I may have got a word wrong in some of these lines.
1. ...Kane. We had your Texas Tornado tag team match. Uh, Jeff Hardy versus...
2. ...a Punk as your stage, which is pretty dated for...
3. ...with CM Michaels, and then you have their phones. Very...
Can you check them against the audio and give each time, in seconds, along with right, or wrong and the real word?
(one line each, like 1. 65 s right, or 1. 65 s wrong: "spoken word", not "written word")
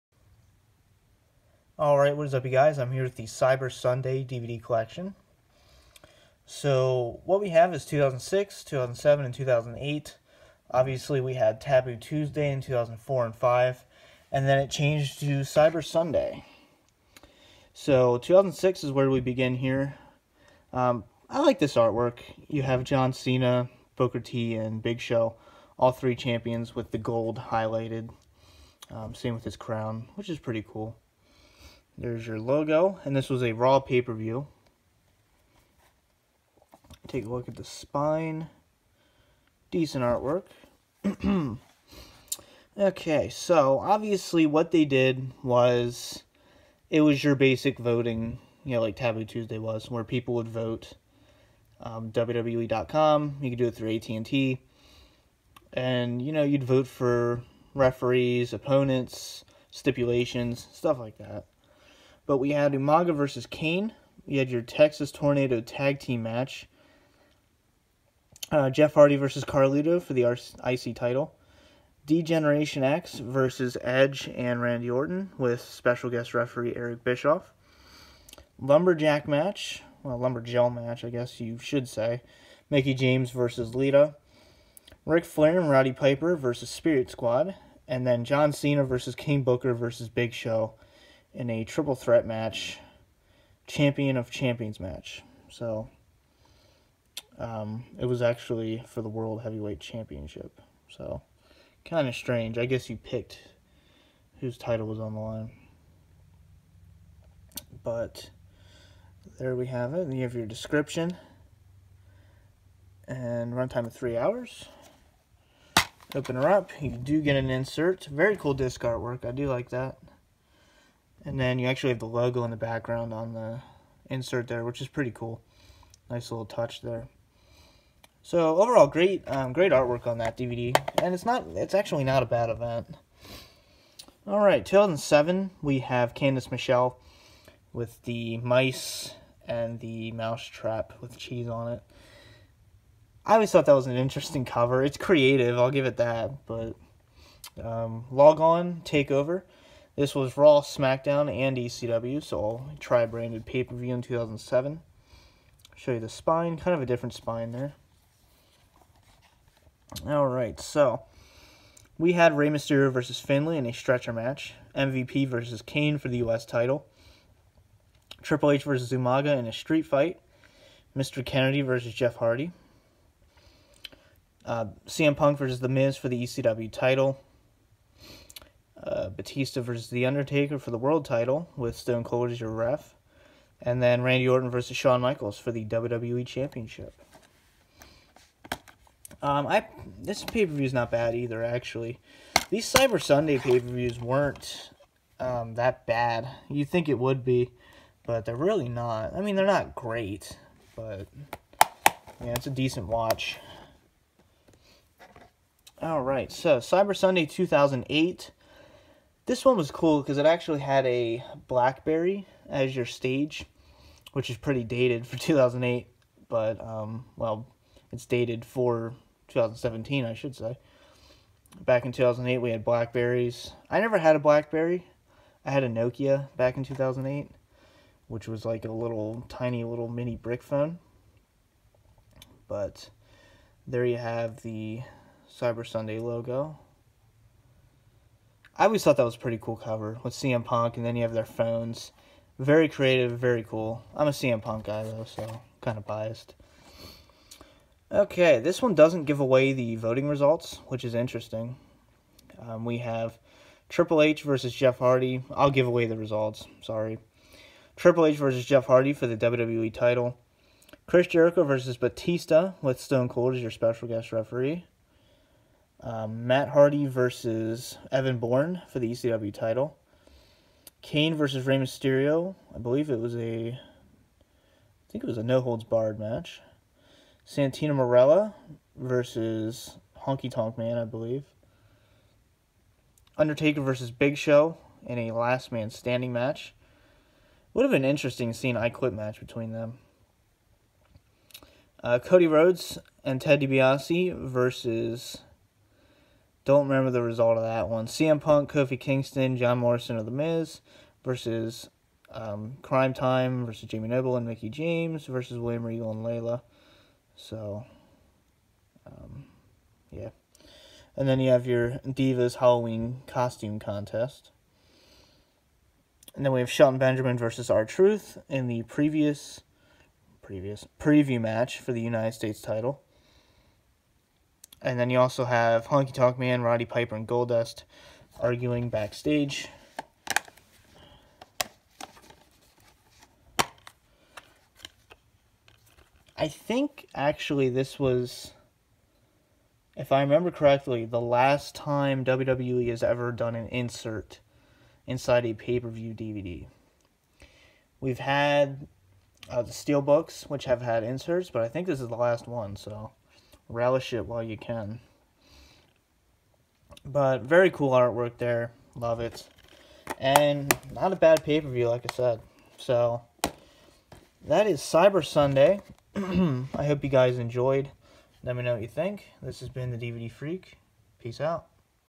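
1. 63 s right
2. 210 s wrong: "BlackBerry", not "Punk"
3. 240 s wrong: "Punk", not "Michaels".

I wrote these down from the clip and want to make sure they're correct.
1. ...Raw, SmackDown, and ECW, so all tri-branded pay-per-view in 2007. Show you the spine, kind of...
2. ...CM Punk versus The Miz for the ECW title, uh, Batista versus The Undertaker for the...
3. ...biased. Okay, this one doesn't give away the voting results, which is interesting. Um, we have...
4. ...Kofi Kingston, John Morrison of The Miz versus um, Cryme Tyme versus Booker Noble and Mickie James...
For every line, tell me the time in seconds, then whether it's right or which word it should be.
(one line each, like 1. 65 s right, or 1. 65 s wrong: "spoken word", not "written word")
1. 150 s right
2. 174 s right
3. 245 s right
4. 298 s wrong: "Jamie", not "Booker".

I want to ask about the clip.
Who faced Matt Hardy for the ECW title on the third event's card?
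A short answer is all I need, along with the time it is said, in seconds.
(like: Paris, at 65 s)
Evan Bourne, at 267 s.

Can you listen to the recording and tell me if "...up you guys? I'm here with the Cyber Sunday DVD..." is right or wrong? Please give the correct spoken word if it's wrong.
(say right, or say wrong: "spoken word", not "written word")
right.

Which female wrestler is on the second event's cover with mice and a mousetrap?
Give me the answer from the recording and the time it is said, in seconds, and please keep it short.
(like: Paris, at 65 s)
Candice Michelle, at 136 s.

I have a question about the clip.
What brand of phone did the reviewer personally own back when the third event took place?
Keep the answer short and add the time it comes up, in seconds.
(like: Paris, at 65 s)
Nokia, at 225 s.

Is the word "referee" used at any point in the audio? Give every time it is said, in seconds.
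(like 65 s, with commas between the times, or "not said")
57 s, 76 s, 264 s.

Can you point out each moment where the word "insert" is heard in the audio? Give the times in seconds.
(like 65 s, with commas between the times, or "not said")
117 s, 124 s, 343 s, 350 s.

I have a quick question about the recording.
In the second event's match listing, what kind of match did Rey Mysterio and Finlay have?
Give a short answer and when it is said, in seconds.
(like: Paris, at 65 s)
Stretcher match, at 163 s.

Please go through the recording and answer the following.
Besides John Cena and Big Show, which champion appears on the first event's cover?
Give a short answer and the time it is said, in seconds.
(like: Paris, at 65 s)
Booker T, at 23 s.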